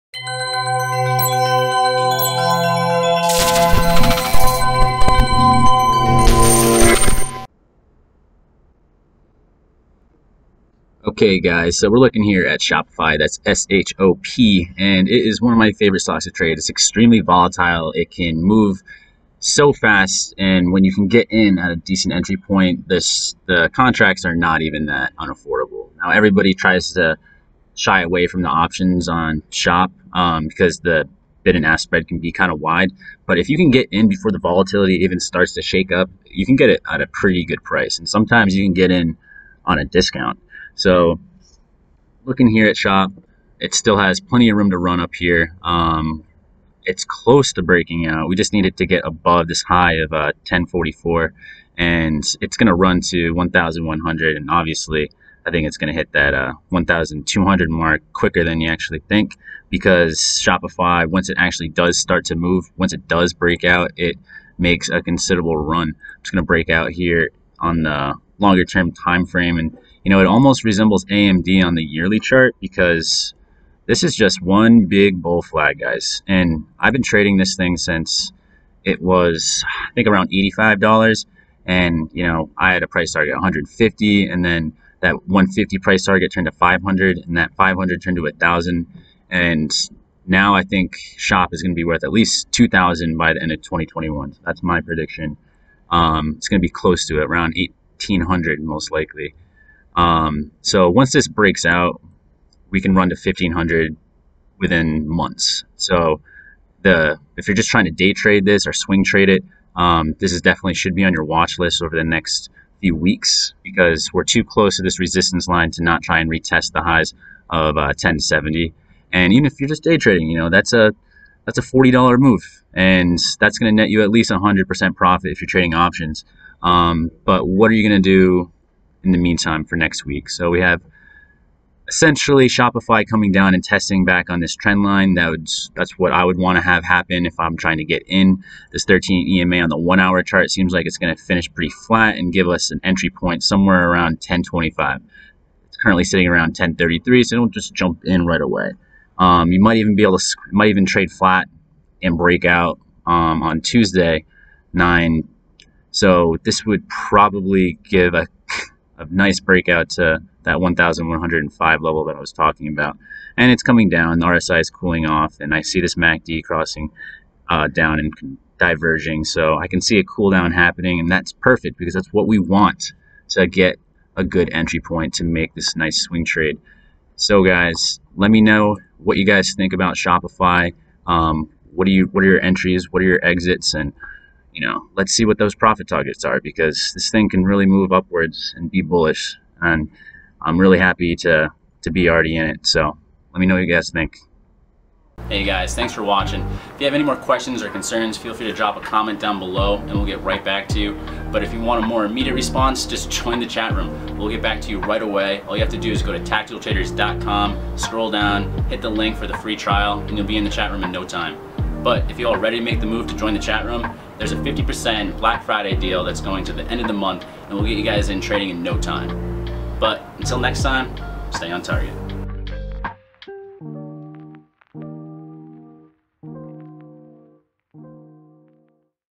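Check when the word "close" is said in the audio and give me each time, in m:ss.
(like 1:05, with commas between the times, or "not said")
0:47, 1:36, 1:54.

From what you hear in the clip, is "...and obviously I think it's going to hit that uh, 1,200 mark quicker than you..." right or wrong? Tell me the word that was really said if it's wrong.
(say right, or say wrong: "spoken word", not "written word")
right.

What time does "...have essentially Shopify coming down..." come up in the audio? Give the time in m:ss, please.
2:10.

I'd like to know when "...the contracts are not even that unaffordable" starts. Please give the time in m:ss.
0:23.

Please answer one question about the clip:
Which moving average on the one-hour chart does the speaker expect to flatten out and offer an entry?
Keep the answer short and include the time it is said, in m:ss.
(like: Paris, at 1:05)
13 EMA, at 2:18.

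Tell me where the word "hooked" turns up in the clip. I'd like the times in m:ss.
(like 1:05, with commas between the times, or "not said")
not said.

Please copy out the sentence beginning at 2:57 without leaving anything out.
So guys, let me know what you guys think about Shopify.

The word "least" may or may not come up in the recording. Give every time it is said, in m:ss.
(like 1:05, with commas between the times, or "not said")
1:32, 2:04.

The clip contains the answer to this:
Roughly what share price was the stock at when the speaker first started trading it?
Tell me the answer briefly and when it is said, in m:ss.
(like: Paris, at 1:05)
$85, at 1:20.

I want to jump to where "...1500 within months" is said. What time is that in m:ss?
1:43.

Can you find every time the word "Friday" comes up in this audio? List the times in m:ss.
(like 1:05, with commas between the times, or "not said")
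3:35.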